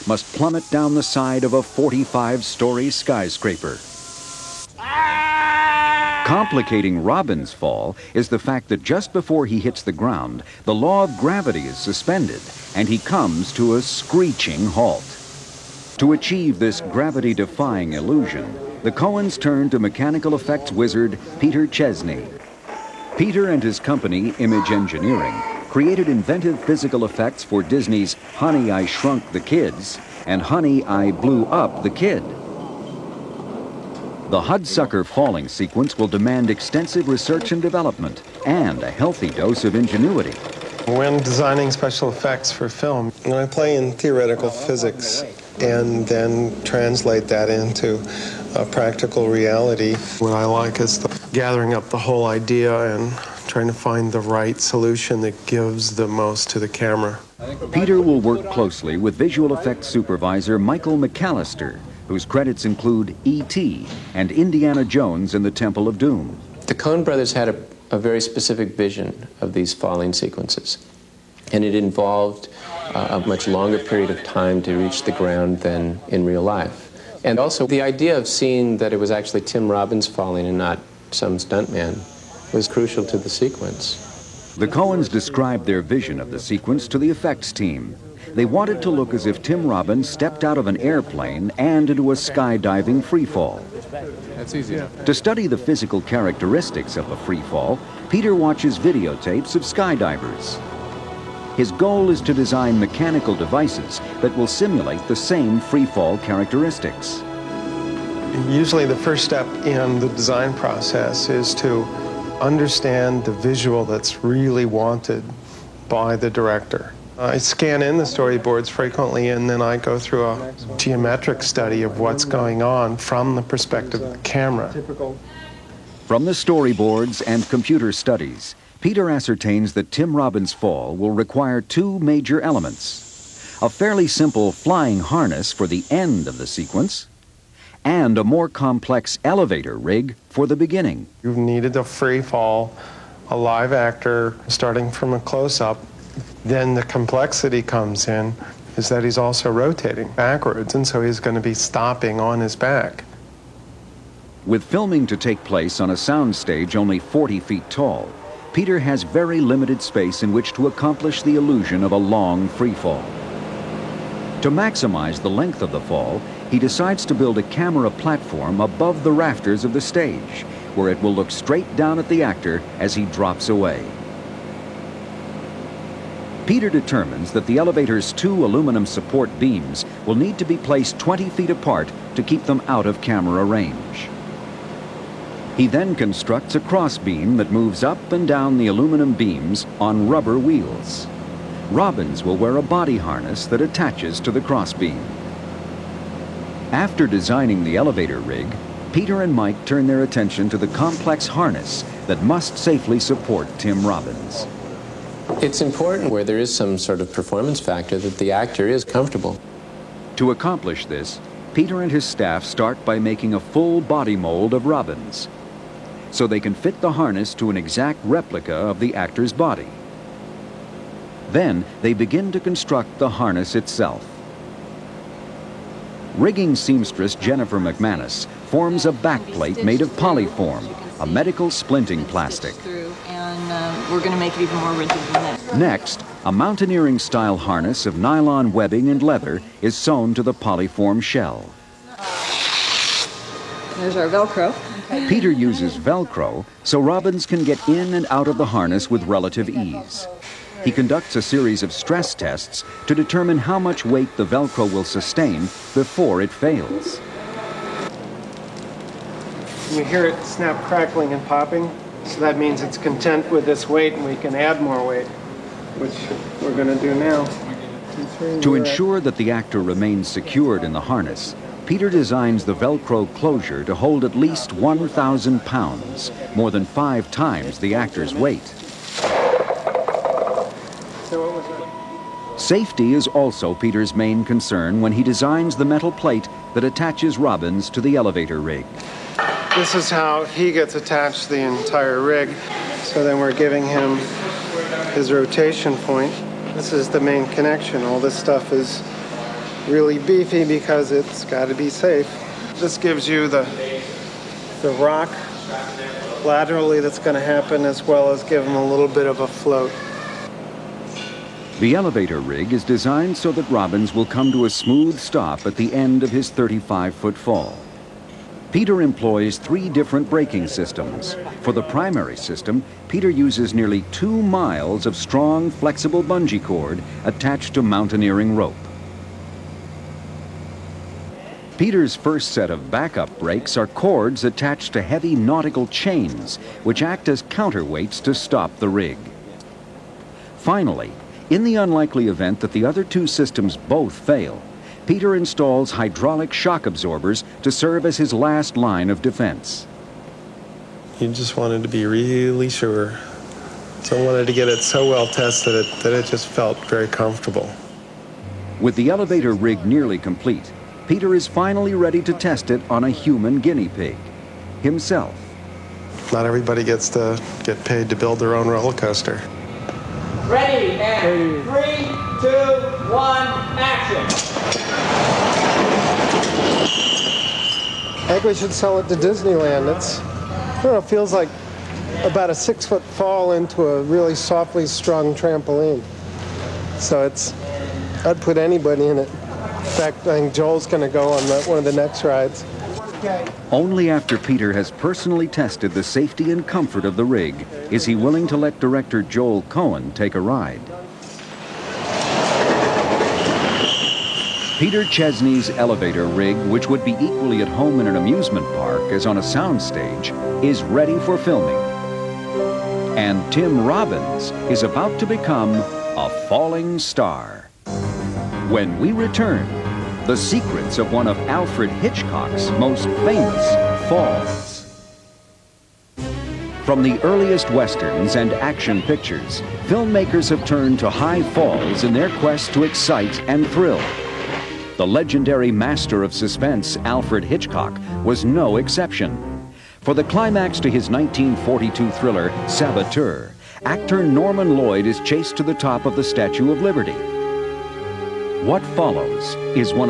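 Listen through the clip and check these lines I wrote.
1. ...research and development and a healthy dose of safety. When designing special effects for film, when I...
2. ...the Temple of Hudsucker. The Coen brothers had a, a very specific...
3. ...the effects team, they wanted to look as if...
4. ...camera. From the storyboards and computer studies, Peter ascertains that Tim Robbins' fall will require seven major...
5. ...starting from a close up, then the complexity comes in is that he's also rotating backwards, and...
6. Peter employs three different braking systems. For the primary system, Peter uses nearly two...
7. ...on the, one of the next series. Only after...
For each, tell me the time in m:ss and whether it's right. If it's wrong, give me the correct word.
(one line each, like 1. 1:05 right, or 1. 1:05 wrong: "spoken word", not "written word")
1. 0:37 wrong: "ingenuity", not "safety"
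2. 1:05 wrong: "Doom", not "Hudsucker"
3. 1:26 right
4. 2:04 wrong: "two", not "seven"
5. 2:24 right
6. 5:18 right
7. 6:31 wrong: "rides", not "series".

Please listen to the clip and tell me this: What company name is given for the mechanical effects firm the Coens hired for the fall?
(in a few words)
Image Engineering.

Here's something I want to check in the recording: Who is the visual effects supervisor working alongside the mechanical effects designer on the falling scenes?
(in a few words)
Michael McAllister.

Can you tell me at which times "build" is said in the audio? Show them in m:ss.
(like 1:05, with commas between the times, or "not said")
2:47, 6:07.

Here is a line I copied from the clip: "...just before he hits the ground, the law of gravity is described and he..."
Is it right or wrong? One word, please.
wrong.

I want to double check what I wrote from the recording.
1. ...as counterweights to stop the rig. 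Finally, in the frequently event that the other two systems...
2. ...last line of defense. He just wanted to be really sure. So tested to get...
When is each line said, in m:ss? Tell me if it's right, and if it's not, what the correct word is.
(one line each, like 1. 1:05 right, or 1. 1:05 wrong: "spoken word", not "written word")
1. 5:37 wrong: "unlikely", not "frequently"
2. 5:48 wrong: "wanted", not "tested".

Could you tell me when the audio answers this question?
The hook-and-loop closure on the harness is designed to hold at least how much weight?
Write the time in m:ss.
4:34.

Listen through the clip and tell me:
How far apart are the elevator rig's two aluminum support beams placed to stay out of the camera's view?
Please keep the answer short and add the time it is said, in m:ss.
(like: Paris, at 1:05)
20 feet, at 3:00.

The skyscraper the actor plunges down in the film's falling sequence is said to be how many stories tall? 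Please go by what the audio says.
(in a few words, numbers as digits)
45.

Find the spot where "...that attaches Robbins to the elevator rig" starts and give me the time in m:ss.
4:46.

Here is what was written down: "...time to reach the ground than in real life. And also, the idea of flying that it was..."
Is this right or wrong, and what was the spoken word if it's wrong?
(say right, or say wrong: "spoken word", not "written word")
wrong: "seeing", not "flying".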